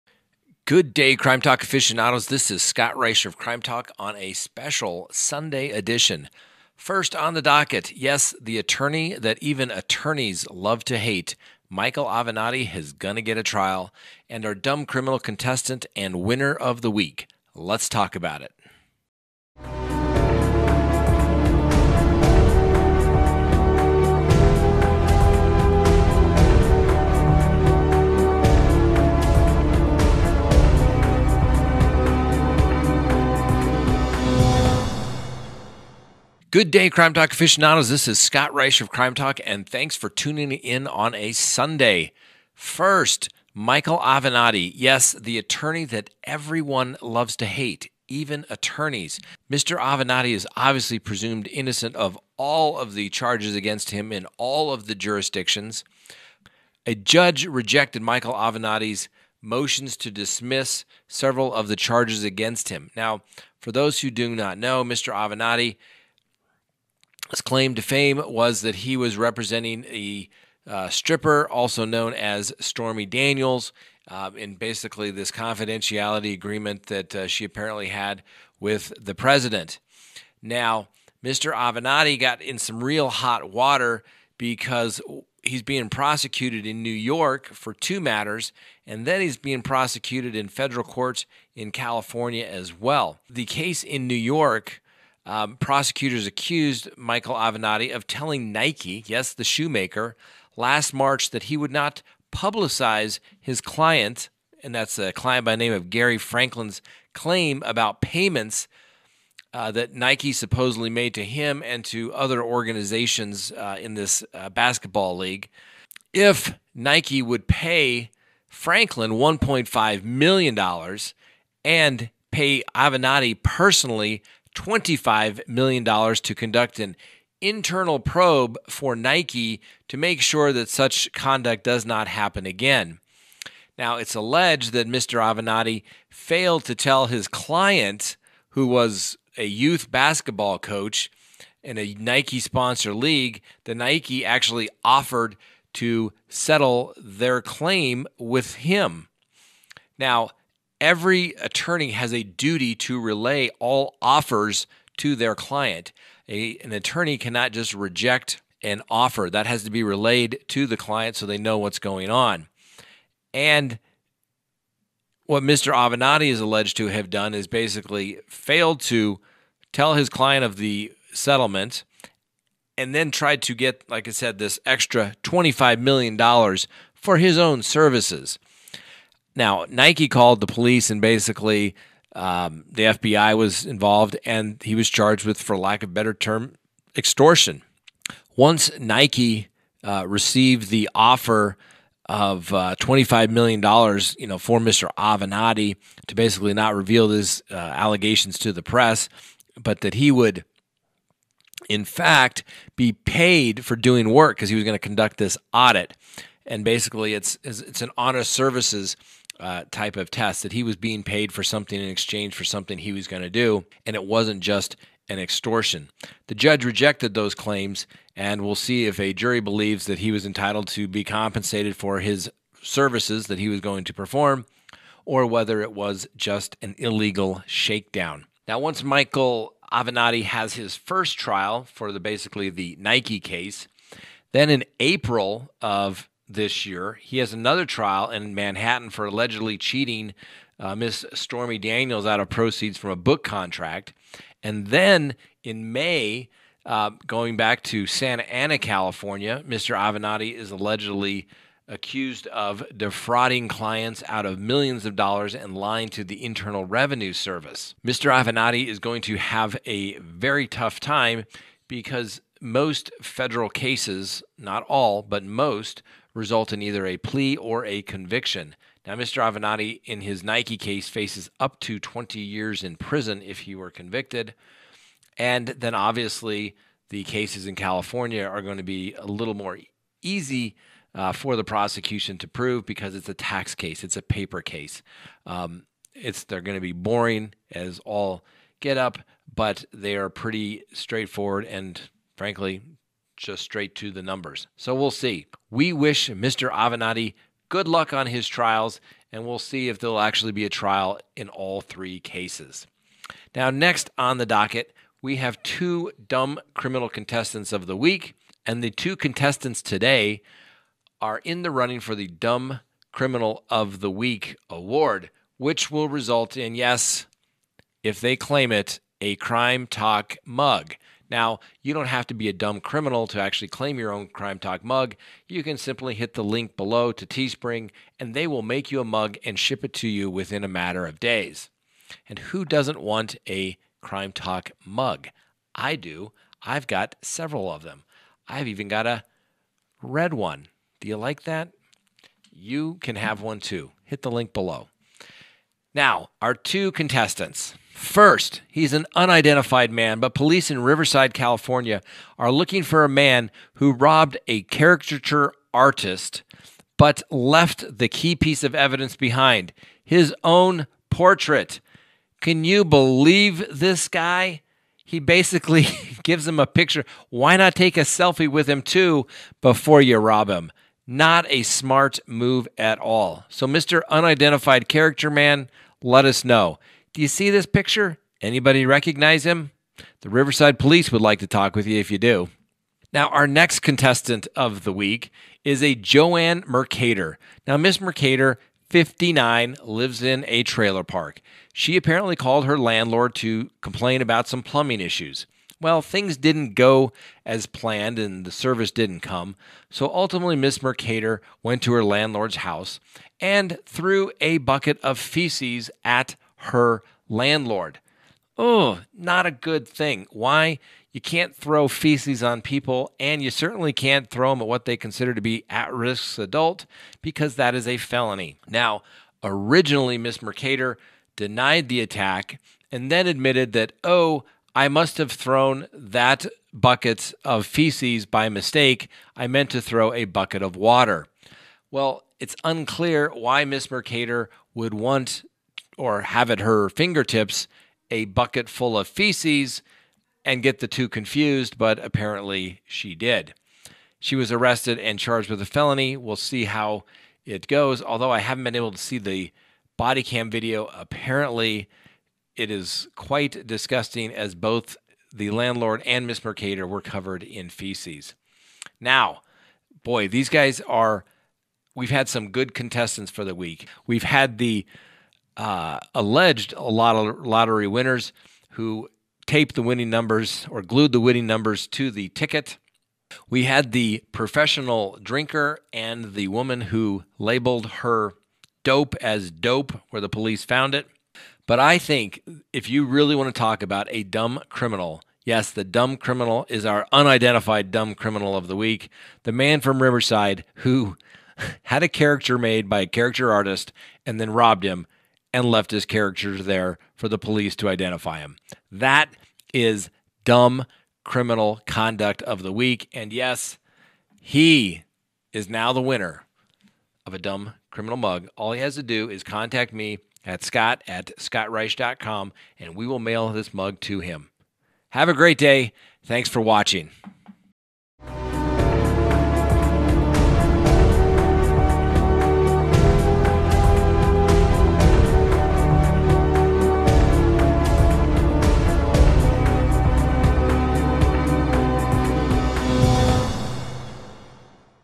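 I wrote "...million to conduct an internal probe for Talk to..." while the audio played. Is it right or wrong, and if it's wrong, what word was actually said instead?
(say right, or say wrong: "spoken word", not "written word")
wrong: "Nike", not "Talk".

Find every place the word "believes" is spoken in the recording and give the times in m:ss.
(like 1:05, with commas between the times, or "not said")
3:39, 6:02.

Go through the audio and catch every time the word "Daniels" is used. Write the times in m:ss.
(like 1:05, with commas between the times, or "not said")
1:13, 4:01.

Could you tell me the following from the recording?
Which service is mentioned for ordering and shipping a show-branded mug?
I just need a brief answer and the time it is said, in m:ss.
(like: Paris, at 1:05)
Teespring, at 5:27.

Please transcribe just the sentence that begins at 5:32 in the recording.
And who doesn't want a Crime Talk mug?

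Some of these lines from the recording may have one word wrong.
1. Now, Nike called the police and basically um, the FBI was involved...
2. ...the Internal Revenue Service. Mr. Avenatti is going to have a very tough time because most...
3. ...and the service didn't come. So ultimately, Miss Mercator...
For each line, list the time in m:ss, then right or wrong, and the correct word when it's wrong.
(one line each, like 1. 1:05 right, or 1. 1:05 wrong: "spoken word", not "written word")
1. 2:59 right
2. 4:16 right
3. 6:37 right.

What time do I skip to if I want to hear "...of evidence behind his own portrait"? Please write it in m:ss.
5:58.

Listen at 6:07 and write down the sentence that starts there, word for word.
Why not take a selfie with him too before you rob him?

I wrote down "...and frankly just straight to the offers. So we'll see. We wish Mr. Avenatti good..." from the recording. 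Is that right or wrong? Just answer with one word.
wrong.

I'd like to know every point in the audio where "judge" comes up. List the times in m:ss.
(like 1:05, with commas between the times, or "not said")
0:56, 3:36.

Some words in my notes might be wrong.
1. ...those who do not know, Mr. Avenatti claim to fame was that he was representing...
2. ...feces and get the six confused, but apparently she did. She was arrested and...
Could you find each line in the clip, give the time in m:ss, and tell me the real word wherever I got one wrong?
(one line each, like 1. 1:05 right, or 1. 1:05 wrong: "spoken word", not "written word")
1. 1:03 right
2. 7:18 wrong: "two", not "six".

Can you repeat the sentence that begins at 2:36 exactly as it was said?
A, an attorney cannot just reject an offer.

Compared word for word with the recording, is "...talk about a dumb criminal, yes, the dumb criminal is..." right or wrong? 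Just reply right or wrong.
right.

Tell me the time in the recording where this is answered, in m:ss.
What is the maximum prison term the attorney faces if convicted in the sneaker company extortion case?
4:31.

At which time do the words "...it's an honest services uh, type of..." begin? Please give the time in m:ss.
3:27.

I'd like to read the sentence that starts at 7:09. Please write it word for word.
I meant to throw a bucket of water.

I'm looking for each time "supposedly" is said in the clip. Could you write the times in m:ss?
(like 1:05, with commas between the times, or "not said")
1:50.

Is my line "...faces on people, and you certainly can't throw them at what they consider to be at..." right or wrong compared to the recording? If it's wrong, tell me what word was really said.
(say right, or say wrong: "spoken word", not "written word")
wrong: "feces", not "faces".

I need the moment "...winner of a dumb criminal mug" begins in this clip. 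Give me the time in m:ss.
8:25.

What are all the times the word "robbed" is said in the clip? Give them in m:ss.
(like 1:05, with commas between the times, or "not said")
5:53, 8:14.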